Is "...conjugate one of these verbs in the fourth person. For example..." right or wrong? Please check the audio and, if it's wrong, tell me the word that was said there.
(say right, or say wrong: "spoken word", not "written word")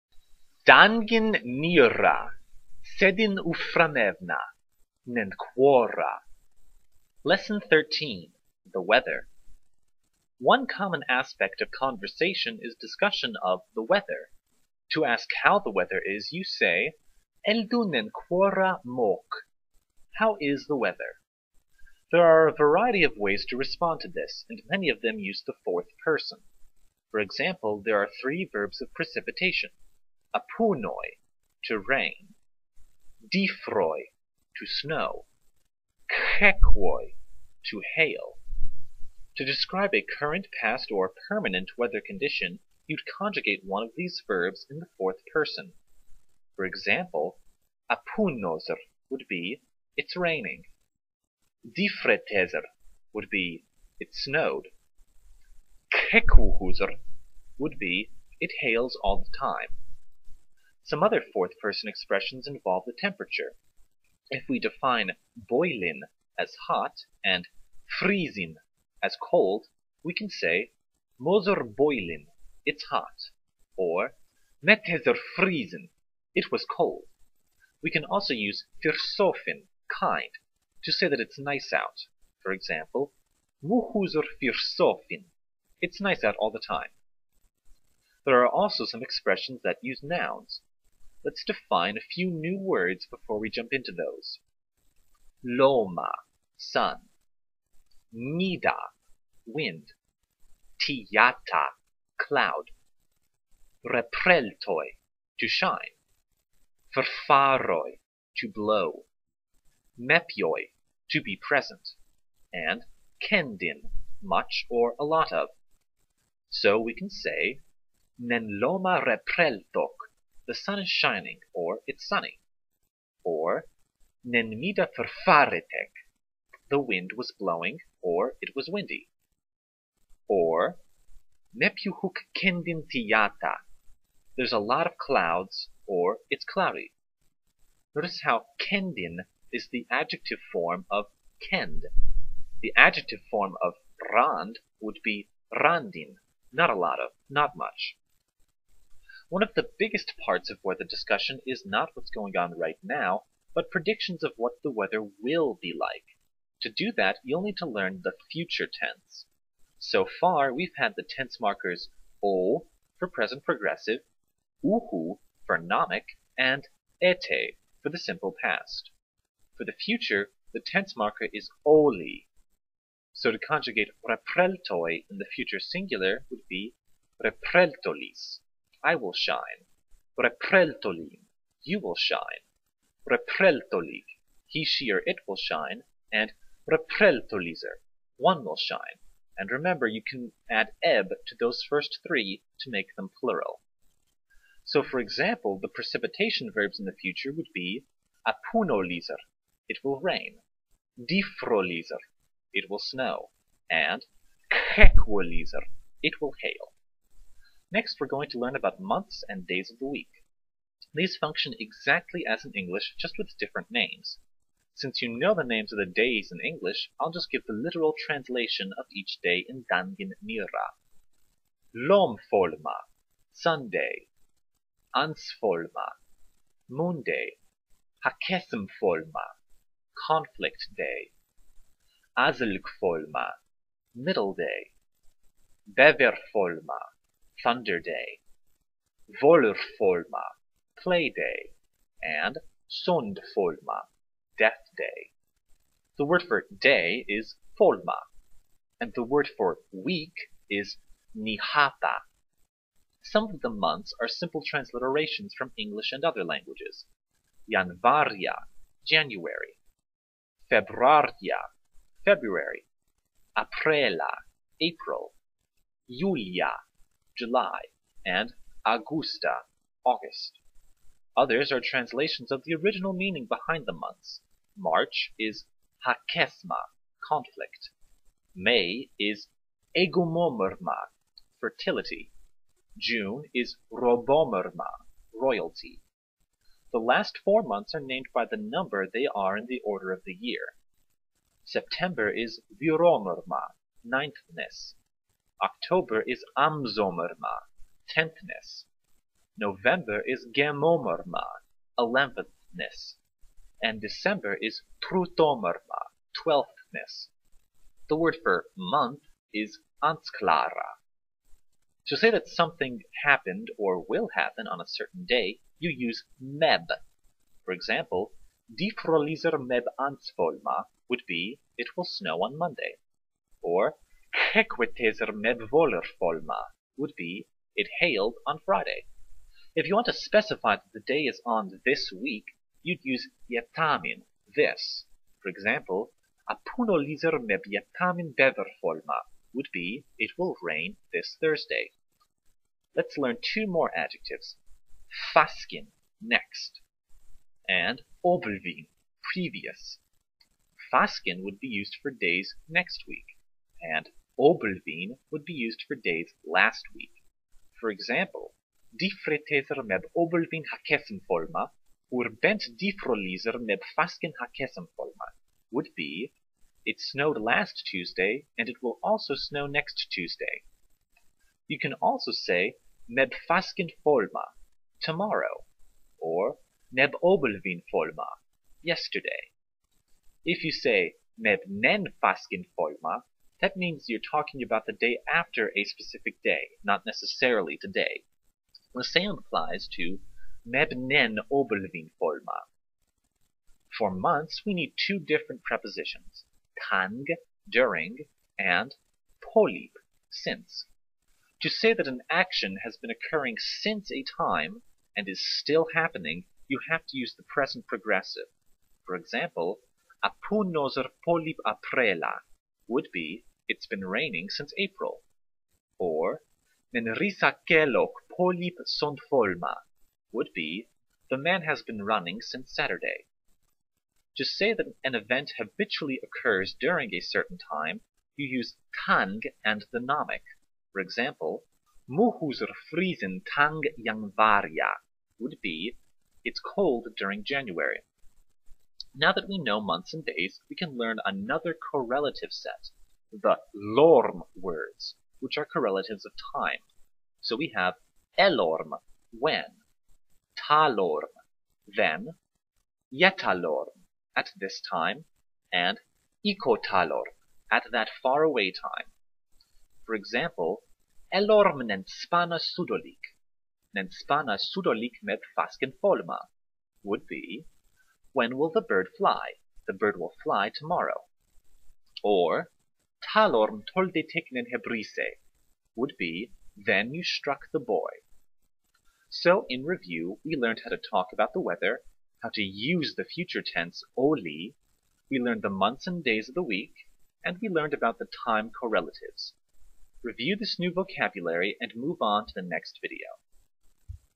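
right.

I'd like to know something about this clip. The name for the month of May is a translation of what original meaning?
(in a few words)
fertility.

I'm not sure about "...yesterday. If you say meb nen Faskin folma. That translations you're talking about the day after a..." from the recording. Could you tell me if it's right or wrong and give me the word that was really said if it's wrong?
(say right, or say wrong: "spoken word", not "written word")
wrong: "means", not "translations".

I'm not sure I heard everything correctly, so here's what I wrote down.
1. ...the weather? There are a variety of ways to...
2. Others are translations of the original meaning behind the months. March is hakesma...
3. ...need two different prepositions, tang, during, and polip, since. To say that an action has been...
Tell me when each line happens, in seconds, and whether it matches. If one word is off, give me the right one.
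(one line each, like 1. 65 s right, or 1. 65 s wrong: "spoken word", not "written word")
1. 20 s right
2. 271 s right
3. 394 s right.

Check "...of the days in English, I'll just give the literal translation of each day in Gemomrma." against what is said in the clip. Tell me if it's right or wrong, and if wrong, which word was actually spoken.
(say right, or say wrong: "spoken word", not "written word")
wrong: "Danganronpa", not "Gemomrma".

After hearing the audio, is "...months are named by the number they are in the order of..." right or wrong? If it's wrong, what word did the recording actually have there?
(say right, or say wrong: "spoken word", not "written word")
right.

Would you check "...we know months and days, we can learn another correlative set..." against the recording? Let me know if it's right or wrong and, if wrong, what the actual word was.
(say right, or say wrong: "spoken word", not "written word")
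right.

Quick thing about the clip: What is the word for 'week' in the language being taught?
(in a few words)
nihata.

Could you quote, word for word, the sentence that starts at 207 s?
Next we're going to learn about months and days of the week.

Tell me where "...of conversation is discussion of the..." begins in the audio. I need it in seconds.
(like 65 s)
11 s.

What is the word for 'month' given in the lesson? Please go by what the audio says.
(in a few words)
ansklara.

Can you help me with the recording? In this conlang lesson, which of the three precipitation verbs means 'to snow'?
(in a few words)
difroi.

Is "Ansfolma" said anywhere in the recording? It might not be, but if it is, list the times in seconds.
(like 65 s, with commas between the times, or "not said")
224 s, 319 s.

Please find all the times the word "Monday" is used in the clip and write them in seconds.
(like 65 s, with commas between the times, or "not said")
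226 s, 322 s.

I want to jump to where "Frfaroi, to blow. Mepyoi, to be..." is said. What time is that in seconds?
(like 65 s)
106 s.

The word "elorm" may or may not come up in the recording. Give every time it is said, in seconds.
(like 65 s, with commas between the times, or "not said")
448 s, 461 s.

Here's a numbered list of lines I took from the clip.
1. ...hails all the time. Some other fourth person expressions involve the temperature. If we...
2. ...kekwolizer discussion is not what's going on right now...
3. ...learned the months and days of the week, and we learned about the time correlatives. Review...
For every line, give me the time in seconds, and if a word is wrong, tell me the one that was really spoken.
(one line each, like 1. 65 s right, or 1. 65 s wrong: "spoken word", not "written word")
1. 58 s right
2. 150 s wrong: "weather", not "kekwolizer"
3. 485 s right.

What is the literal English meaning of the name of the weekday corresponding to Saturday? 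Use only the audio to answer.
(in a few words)
Death Day.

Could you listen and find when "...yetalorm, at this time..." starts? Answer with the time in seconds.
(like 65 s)
452 s.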